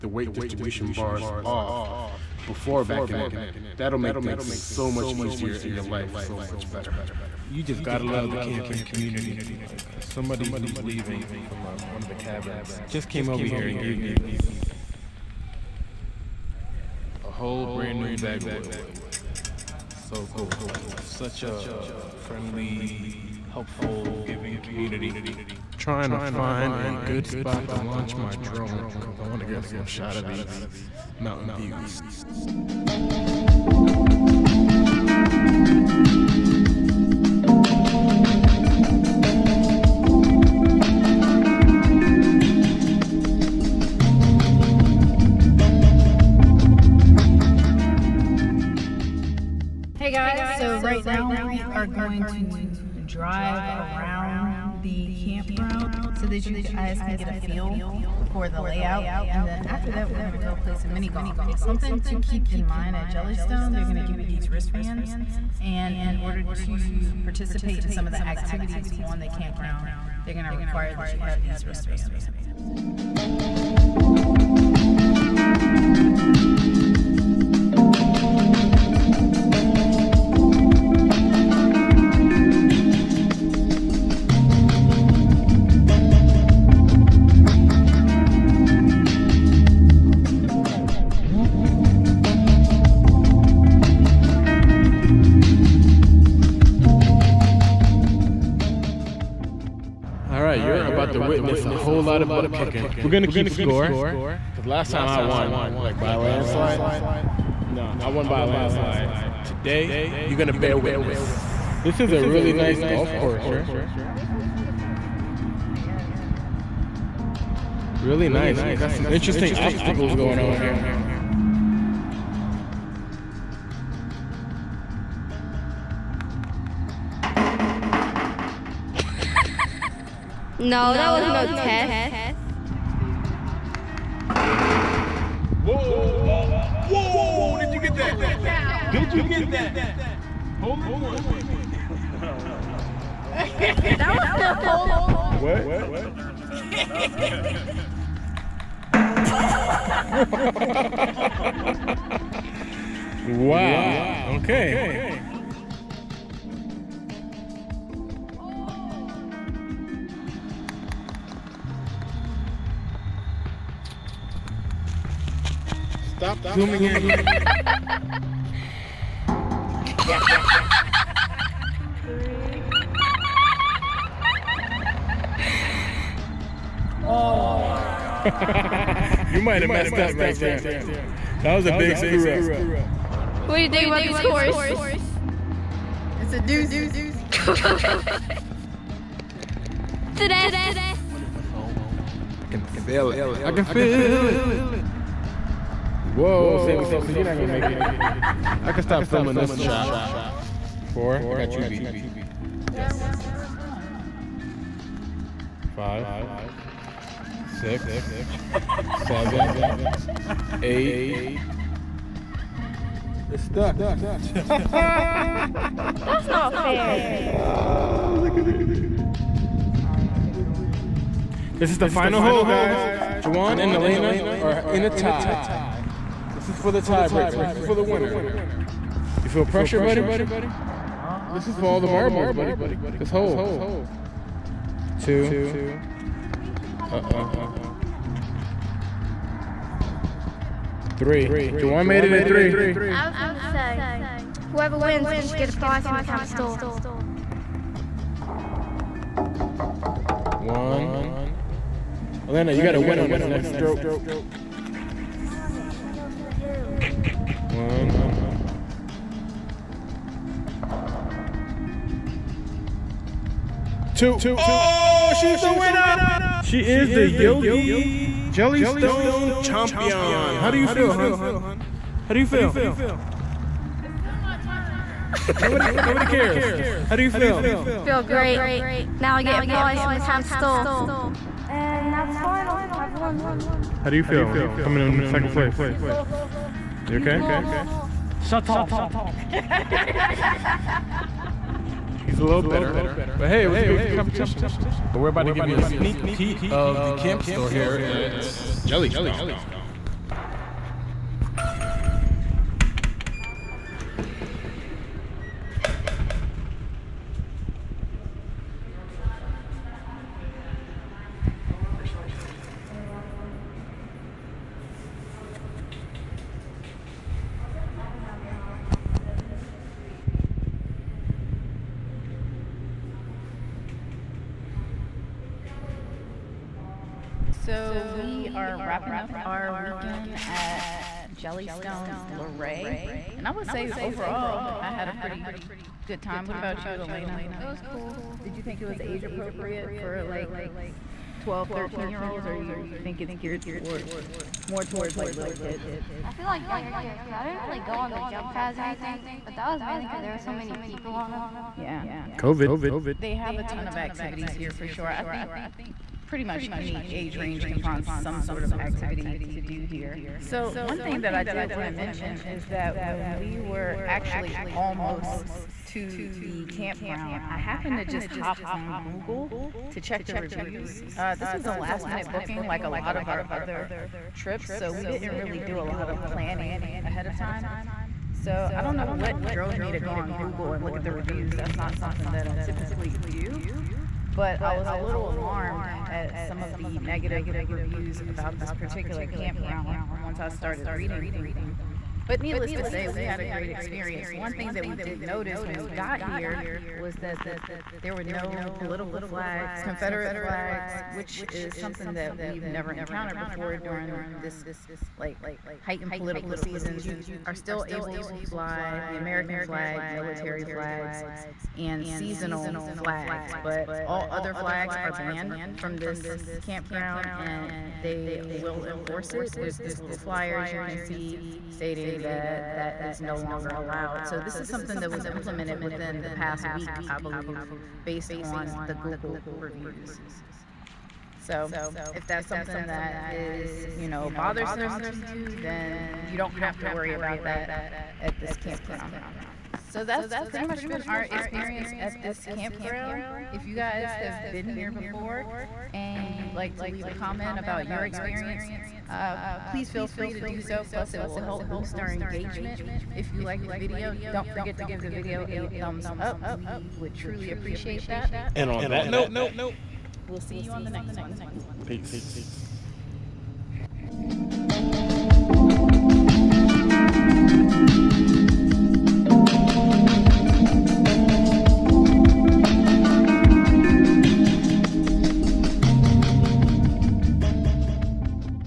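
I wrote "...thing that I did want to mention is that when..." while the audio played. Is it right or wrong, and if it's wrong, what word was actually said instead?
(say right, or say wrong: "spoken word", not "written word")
right.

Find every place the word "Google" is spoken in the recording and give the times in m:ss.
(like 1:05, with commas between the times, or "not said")
6:08, 6:20, 7:08.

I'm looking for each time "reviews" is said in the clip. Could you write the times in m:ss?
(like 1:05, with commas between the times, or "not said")
6:10, 6:20, 6:27, 7:09.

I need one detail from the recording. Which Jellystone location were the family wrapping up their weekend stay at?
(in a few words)
Luray.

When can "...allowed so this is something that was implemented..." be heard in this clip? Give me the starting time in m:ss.
7:03.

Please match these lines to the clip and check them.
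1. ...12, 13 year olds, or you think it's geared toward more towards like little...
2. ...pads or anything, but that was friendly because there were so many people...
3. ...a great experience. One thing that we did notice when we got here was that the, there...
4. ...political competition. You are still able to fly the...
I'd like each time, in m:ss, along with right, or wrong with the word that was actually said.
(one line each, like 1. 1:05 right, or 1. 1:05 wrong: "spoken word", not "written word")
1. 5:41 right
2. 5:48 wrong: "mainly", not "friendly"
3. 6:33 right
4. 6:45 wrong: "season", not "competition".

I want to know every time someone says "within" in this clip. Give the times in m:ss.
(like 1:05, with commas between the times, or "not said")
7:05.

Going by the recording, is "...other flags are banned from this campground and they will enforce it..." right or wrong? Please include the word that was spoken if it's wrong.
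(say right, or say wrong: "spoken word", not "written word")
right.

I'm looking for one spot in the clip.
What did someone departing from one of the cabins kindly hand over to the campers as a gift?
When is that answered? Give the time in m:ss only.
0:18.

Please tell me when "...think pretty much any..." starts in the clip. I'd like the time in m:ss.
5:55.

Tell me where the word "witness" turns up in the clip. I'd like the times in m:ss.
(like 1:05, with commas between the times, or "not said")
1:41, 1:50.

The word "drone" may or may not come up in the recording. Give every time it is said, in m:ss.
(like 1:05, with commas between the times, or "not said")
0:28.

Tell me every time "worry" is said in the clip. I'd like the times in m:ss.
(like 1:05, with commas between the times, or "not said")
7:16.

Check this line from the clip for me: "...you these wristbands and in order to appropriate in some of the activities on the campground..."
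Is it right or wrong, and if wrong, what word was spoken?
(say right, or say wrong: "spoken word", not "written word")
wrong: "participate", not "appropriate".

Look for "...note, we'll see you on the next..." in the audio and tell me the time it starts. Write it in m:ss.
7:38.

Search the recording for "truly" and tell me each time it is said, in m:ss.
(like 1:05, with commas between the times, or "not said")
7:36.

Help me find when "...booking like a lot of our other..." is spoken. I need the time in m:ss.
6:12.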